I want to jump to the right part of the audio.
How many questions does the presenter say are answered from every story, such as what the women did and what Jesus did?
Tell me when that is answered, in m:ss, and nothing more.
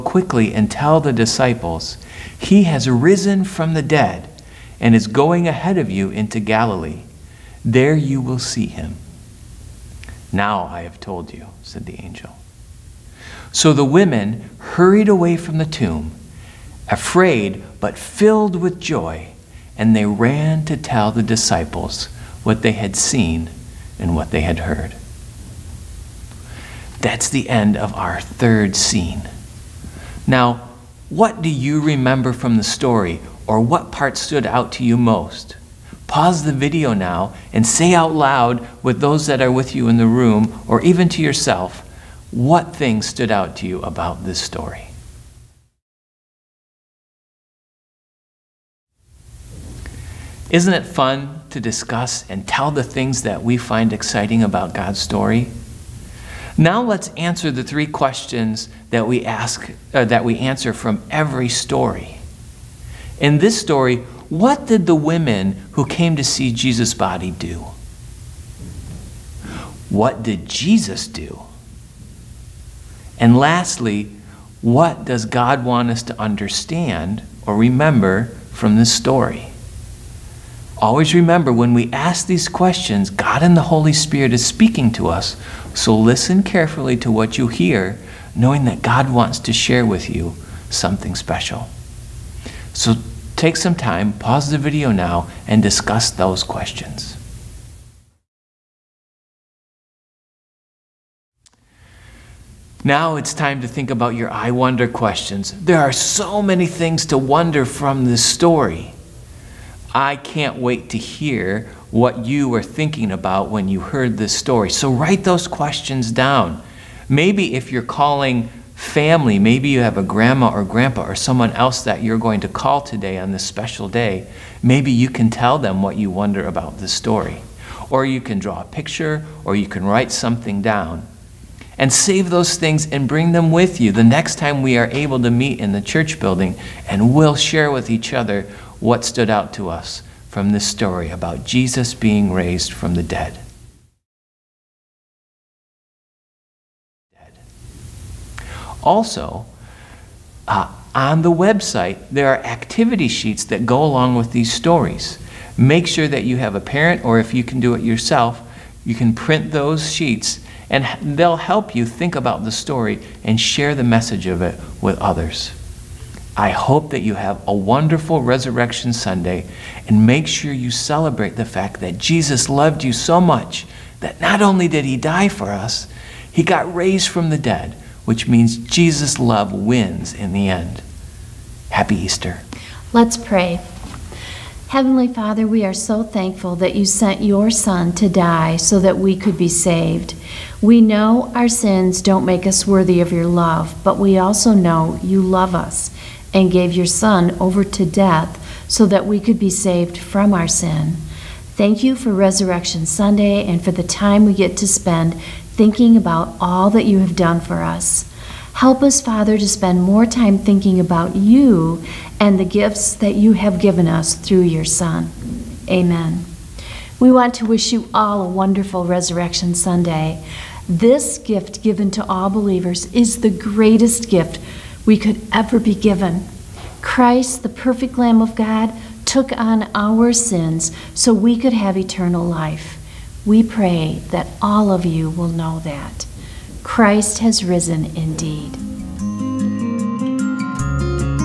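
0:57.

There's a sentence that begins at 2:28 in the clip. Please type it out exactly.
Also, uh, on the website, there are activity sheets that go along with these stories.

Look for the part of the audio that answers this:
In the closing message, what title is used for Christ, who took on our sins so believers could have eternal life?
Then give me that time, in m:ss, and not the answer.
3:47.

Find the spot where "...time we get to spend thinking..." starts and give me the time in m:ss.
3:23.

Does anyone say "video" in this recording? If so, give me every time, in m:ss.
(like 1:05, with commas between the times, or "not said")
0:36, 1:34.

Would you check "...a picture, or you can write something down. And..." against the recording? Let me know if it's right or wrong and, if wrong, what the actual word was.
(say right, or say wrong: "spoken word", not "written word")
right.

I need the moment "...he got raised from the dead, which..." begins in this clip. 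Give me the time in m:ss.
2:56.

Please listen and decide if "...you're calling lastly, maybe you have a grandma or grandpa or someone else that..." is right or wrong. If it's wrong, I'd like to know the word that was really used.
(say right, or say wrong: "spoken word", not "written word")
wrong: "family", not "lastly".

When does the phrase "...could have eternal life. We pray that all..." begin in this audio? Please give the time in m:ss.
3:51.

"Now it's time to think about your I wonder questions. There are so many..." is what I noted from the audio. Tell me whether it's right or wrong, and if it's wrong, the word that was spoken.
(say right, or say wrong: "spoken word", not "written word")
right.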